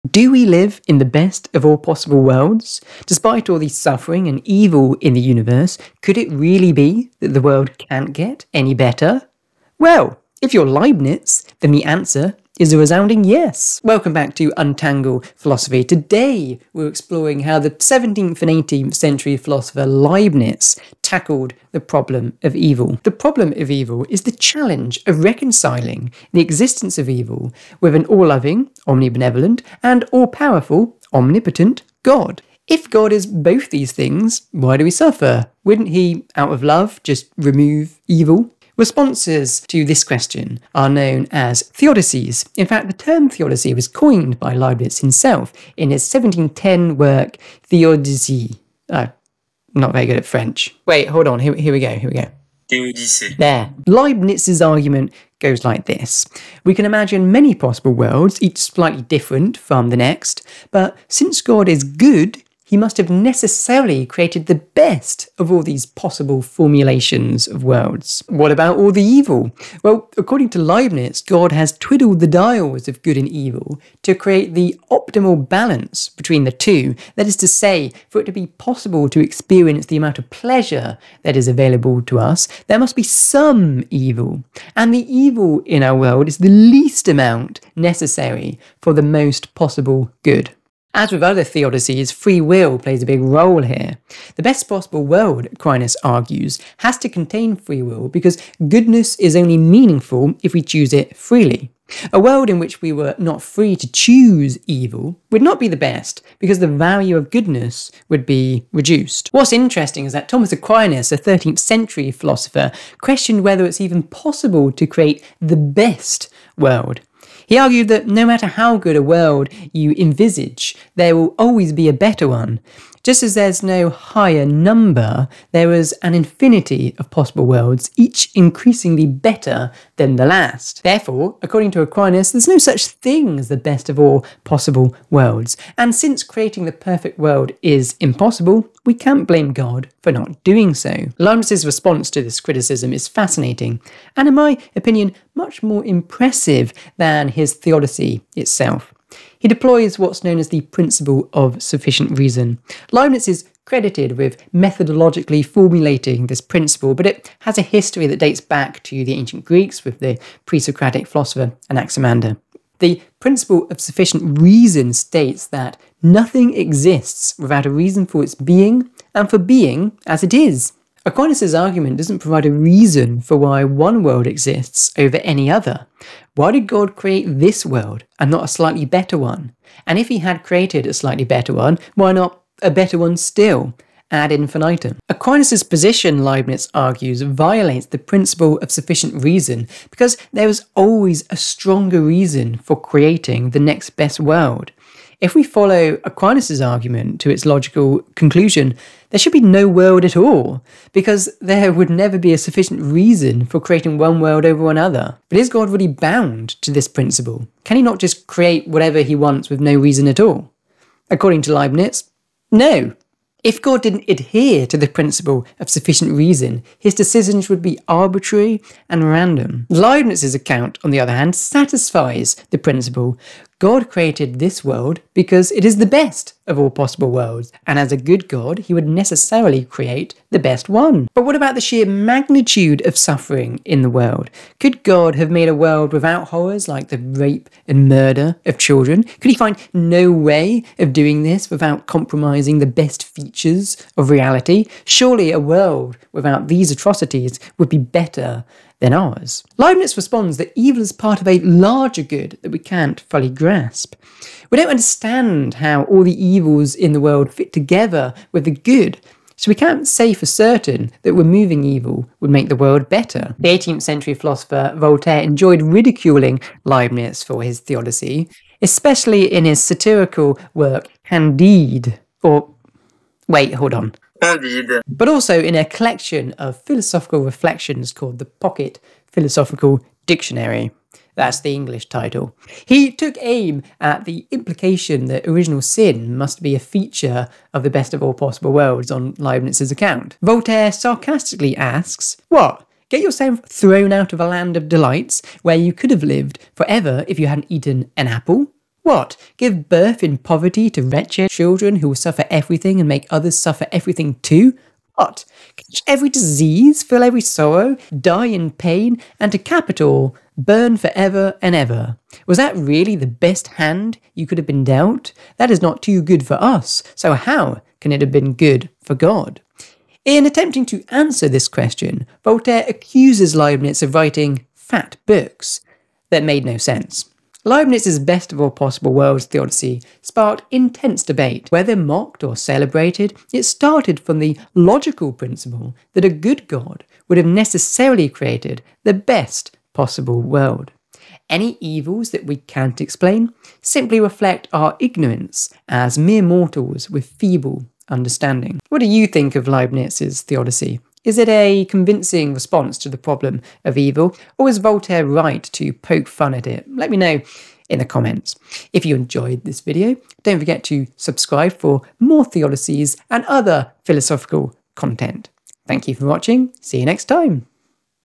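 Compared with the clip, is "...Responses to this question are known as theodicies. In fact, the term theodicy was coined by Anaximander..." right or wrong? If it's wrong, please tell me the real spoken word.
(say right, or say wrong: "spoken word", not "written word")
wrong: "Leibniz", not "Anaximander".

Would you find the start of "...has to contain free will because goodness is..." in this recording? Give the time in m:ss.
1:36.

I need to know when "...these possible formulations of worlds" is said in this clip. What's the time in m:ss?
1:05.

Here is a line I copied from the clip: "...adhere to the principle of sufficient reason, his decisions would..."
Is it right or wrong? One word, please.
right.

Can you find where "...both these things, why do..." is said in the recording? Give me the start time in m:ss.
0:33.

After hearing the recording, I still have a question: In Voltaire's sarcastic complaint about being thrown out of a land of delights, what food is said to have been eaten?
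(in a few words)
An apple.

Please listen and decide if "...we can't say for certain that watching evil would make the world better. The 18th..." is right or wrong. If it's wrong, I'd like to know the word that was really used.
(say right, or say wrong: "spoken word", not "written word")
wrong: "removing", not "watching".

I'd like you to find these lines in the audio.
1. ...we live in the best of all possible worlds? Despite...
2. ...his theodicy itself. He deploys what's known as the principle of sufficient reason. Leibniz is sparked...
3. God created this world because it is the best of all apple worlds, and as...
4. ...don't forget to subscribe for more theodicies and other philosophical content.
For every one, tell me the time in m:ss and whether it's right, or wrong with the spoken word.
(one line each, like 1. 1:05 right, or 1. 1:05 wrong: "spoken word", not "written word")
1. 0:00 right
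2. 2:27 wrong: "credited", not "sparked"
3. 3:43 wrong: "possible", not "apple"
4. 6:00 right.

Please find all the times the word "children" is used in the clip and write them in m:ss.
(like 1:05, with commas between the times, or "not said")
3:58, 5:01.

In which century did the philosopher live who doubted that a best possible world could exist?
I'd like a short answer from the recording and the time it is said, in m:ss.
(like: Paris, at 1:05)
13th century, at 1:51.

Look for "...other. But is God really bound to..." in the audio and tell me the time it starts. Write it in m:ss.
3:24.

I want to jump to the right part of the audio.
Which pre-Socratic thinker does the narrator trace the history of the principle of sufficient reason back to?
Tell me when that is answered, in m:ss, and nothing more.
2:41.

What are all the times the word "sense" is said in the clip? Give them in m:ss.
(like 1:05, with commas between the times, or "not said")
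5:26.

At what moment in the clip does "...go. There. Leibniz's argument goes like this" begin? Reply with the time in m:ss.
0:52.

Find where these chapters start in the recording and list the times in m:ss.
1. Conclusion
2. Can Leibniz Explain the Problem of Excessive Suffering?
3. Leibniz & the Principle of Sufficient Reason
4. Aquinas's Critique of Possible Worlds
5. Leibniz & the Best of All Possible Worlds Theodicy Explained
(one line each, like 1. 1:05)
1. 5:27
2. 3:50
3. 2:20
4. 1:49
5. 0:53.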